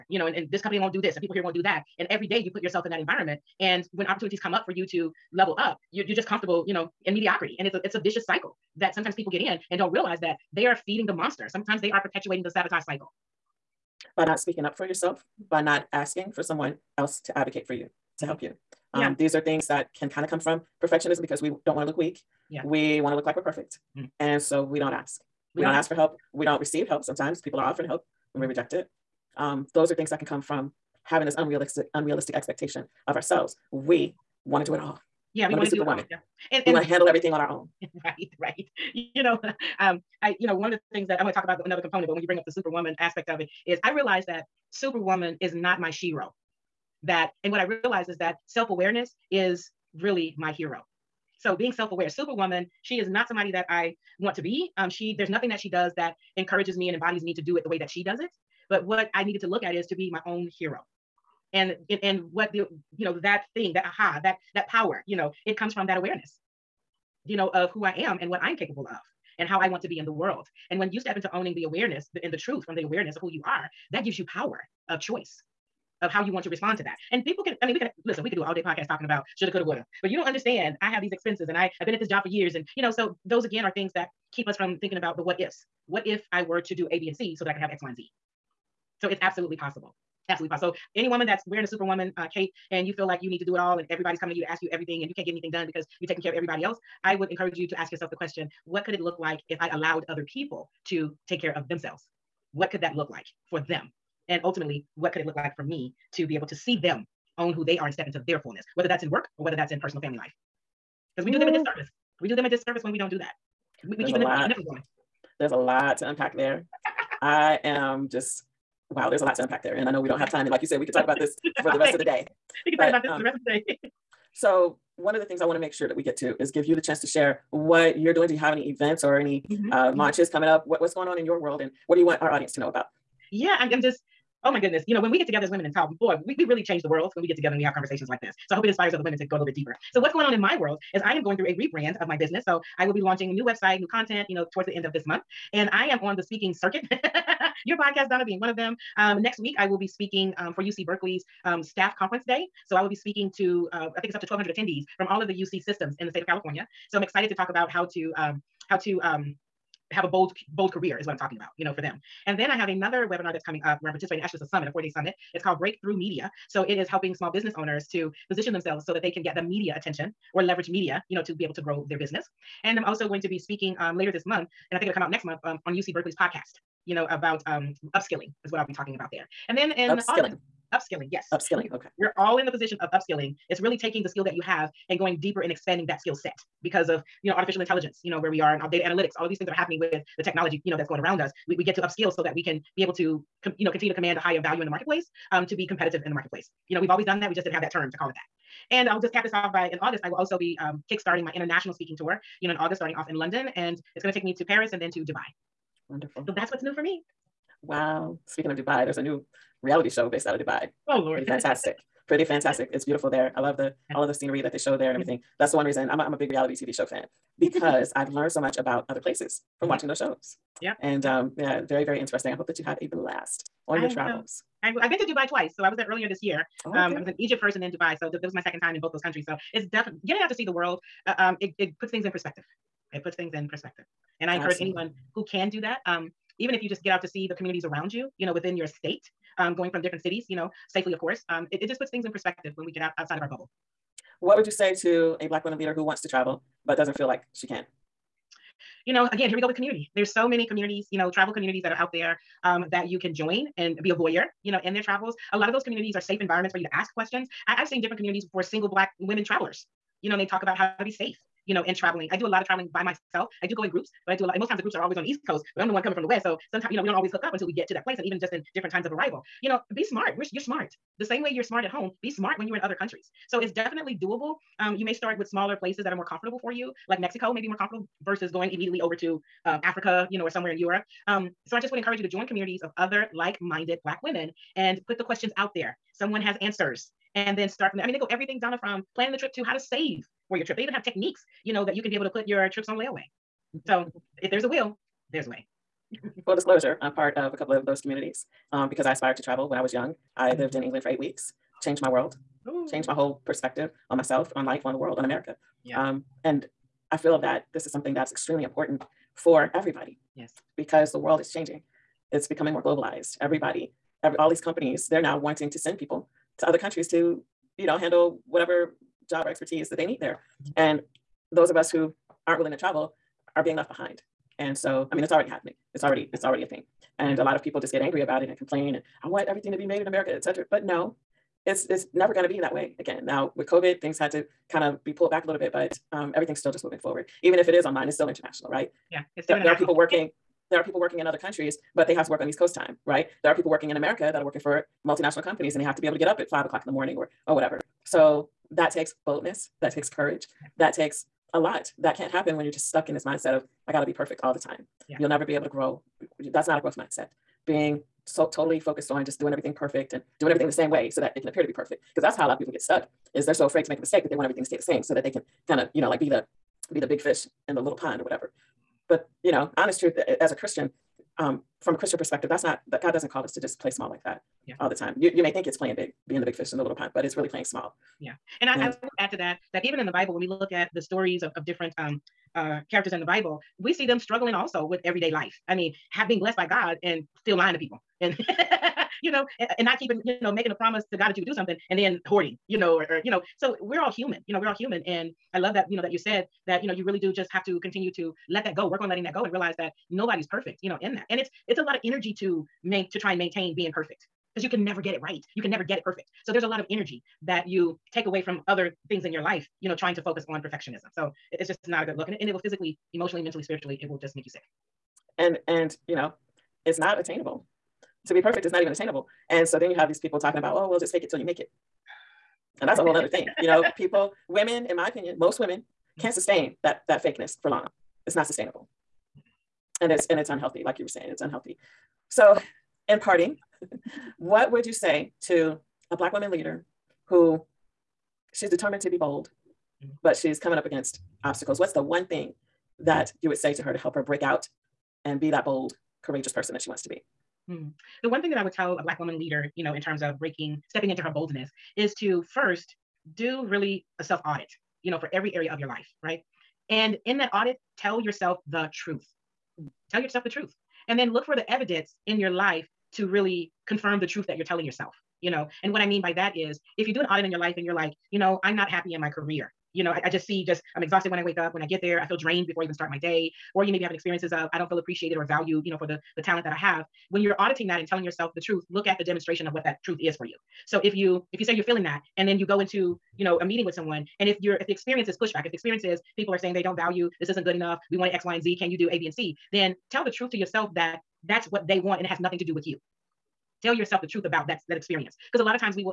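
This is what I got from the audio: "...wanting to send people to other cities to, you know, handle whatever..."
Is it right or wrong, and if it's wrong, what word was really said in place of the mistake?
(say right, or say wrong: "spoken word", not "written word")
wrong: "countries", not "cities".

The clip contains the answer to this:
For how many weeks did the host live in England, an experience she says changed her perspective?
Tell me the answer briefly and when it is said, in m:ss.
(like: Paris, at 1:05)
8, at 5:00.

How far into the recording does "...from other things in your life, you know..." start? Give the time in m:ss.
6:48.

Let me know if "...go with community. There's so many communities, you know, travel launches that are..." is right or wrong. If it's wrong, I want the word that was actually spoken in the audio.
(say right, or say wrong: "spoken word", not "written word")
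wrong: "communities", not "launches".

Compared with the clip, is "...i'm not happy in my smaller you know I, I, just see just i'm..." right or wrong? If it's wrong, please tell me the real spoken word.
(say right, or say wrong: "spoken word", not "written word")
wrong: "career", not "smaller".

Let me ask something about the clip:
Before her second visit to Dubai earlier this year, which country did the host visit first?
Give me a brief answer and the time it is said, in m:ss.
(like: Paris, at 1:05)
Egypt, at 3:47.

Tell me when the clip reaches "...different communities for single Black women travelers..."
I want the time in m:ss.
4:17.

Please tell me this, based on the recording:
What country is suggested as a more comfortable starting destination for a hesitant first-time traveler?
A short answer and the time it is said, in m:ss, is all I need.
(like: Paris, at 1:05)
Mexico, at 4:36.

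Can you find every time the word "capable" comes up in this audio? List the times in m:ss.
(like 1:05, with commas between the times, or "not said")
1:08.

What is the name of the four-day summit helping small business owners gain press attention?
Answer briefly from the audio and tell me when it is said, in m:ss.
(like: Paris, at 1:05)
Breakthrough Media, at 2:45.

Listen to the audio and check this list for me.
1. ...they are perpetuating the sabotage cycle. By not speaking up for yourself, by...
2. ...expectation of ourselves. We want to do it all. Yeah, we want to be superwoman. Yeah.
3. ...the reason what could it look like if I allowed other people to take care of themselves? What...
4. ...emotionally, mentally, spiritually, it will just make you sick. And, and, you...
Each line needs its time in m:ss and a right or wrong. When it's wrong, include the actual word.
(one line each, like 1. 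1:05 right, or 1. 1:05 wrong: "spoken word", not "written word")
1. 0:11 right
2. 0:32 right
3. 1:38 wrong: "question", not "reason"
4. 6:52 right.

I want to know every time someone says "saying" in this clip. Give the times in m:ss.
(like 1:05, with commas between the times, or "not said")
7:10, 8:06.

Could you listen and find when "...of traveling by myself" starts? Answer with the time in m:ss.
4:22.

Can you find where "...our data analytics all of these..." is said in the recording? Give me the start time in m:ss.
3:08.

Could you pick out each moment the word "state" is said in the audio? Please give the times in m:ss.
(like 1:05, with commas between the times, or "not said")
2:36, 3:58.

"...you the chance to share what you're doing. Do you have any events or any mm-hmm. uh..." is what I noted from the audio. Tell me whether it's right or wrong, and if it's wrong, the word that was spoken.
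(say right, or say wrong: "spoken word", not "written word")
right.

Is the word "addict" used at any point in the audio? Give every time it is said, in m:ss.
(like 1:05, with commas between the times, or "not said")
not said.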